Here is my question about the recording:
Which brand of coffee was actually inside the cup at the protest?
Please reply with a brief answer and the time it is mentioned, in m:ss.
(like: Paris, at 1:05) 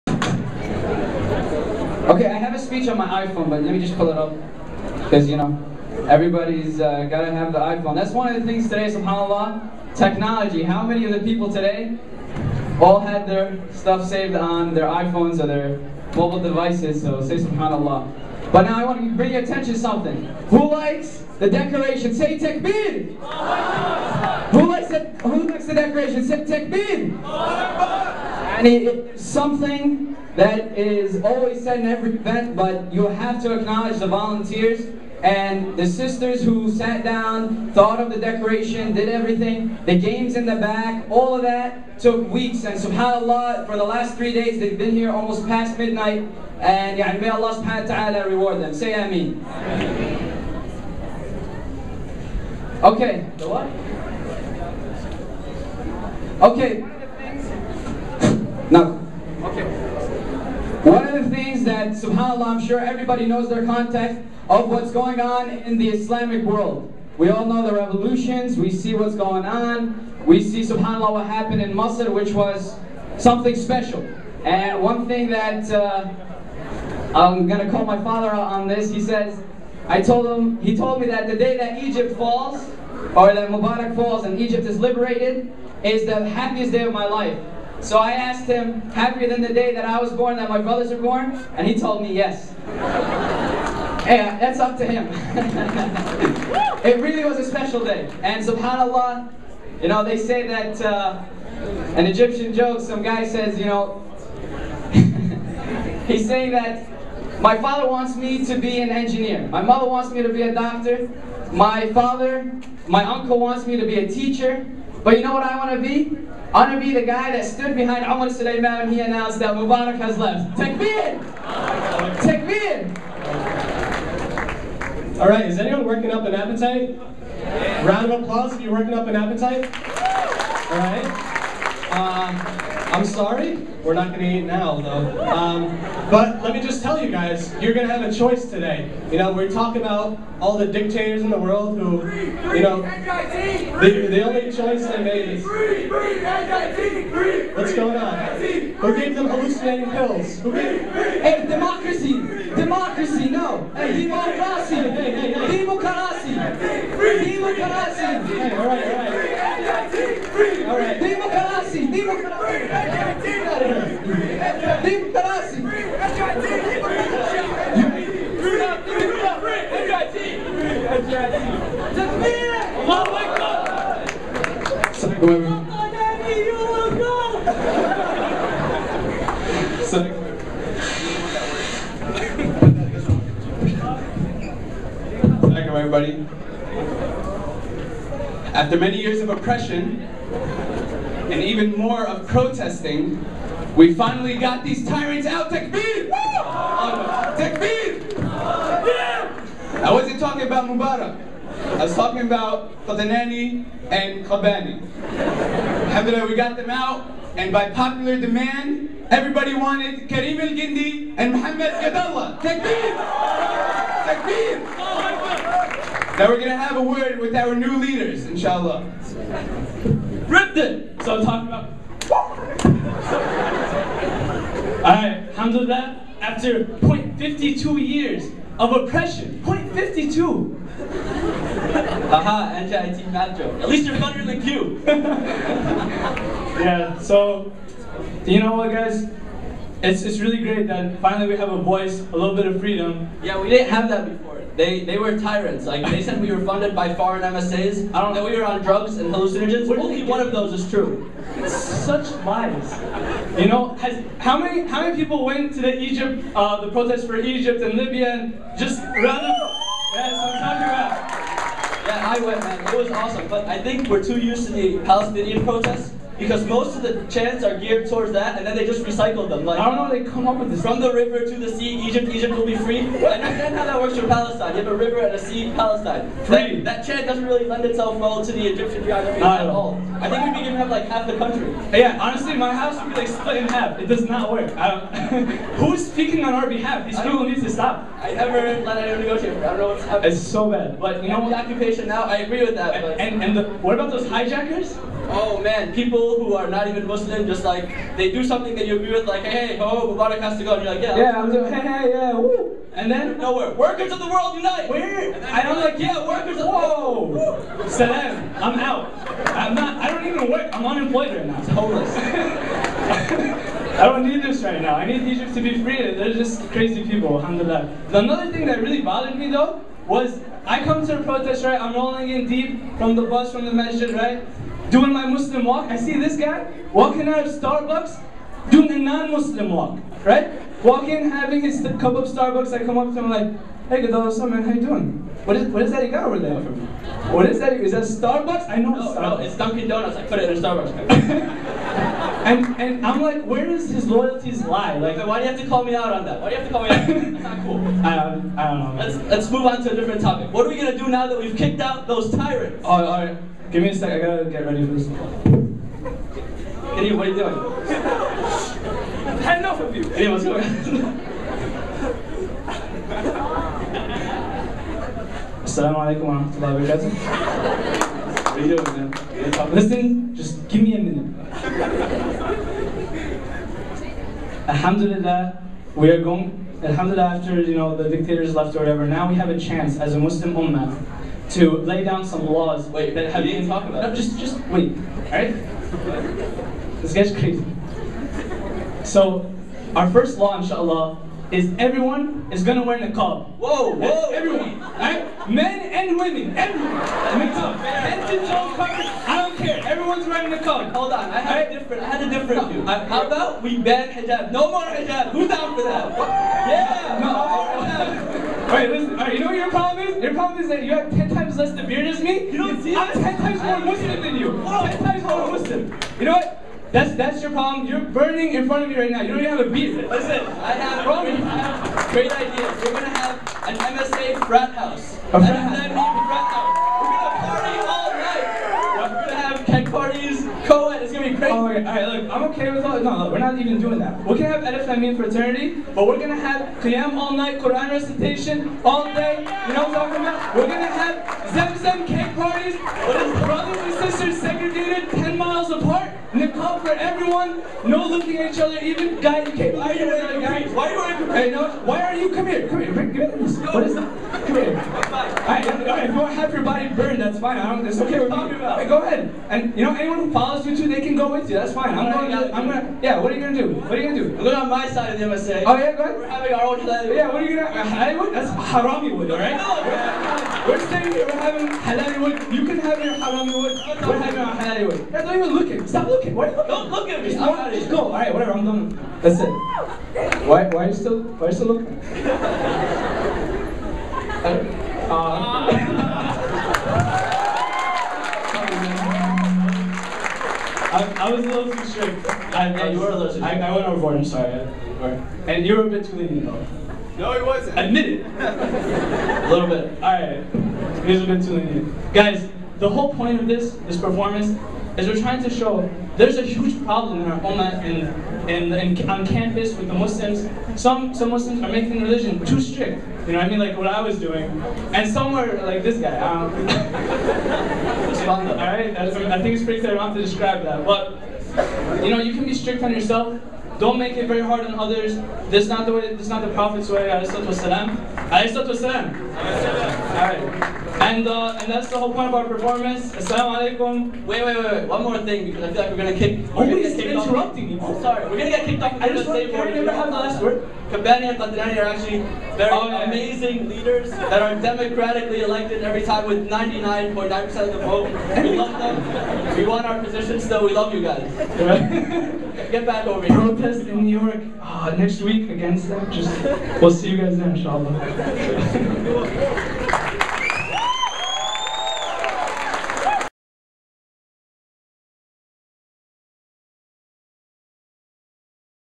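Dunkin' Donuts, at 5:39.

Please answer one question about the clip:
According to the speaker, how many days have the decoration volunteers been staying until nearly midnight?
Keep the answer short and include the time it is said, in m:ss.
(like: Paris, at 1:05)
3, at 0:44.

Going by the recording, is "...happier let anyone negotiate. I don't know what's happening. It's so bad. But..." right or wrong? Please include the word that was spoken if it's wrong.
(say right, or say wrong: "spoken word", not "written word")
wrong: "never", not "happier".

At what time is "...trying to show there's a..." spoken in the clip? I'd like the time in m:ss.
8:25.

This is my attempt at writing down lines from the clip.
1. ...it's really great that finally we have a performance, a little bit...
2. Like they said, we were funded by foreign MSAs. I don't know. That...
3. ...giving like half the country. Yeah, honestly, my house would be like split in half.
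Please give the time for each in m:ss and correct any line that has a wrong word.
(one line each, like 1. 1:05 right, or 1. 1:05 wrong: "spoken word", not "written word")
1. 4:00 wrong: "voice", not "performance"
2. 4:05 right
3. 4:40 right.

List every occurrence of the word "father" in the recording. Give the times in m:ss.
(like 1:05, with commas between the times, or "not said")
1:18, 1:47, 1:51.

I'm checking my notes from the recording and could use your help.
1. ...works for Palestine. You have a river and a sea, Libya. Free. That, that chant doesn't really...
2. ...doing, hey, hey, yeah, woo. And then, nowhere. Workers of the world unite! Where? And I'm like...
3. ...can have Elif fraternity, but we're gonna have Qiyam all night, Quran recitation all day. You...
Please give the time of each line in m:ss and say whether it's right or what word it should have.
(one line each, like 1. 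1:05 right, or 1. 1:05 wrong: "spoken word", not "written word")
1. 4:33 wrong: "Palestine", not "Libya"
2. 5:01 right
3. 7:14 right.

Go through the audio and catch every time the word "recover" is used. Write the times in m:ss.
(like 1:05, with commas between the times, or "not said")
not said.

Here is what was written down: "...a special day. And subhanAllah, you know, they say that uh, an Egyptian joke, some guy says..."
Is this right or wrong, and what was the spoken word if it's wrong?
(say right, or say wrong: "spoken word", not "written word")
right.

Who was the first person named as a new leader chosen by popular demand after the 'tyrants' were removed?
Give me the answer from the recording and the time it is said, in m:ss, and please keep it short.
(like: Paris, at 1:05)
Kareem El Gendi, at 3:30.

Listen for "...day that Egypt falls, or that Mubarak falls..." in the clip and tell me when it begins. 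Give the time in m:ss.
1:21.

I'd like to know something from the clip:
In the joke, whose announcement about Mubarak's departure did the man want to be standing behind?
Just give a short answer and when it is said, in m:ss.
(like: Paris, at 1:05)
Umar Sulaiman, at 1:58.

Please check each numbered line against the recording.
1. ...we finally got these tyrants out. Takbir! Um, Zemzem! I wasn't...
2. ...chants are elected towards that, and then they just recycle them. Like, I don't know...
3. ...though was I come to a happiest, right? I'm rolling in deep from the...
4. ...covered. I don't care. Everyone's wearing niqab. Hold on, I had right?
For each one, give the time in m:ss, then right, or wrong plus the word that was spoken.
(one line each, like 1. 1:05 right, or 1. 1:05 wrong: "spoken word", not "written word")
1. 3:13 wrong: "Takbir", not "Zemzem"
2. 4:27 wrong: "geared", not "elected"
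3. 5:19 wrong: "protest", not "happiest"
4. 6:38 right.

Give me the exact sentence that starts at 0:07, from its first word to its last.
That's one of the things today, subhanAllah, technology.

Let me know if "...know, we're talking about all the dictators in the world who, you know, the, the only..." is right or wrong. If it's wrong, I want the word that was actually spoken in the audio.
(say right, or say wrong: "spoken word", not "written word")
right.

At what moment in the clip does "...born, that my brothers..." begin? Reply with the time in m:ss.
1:30.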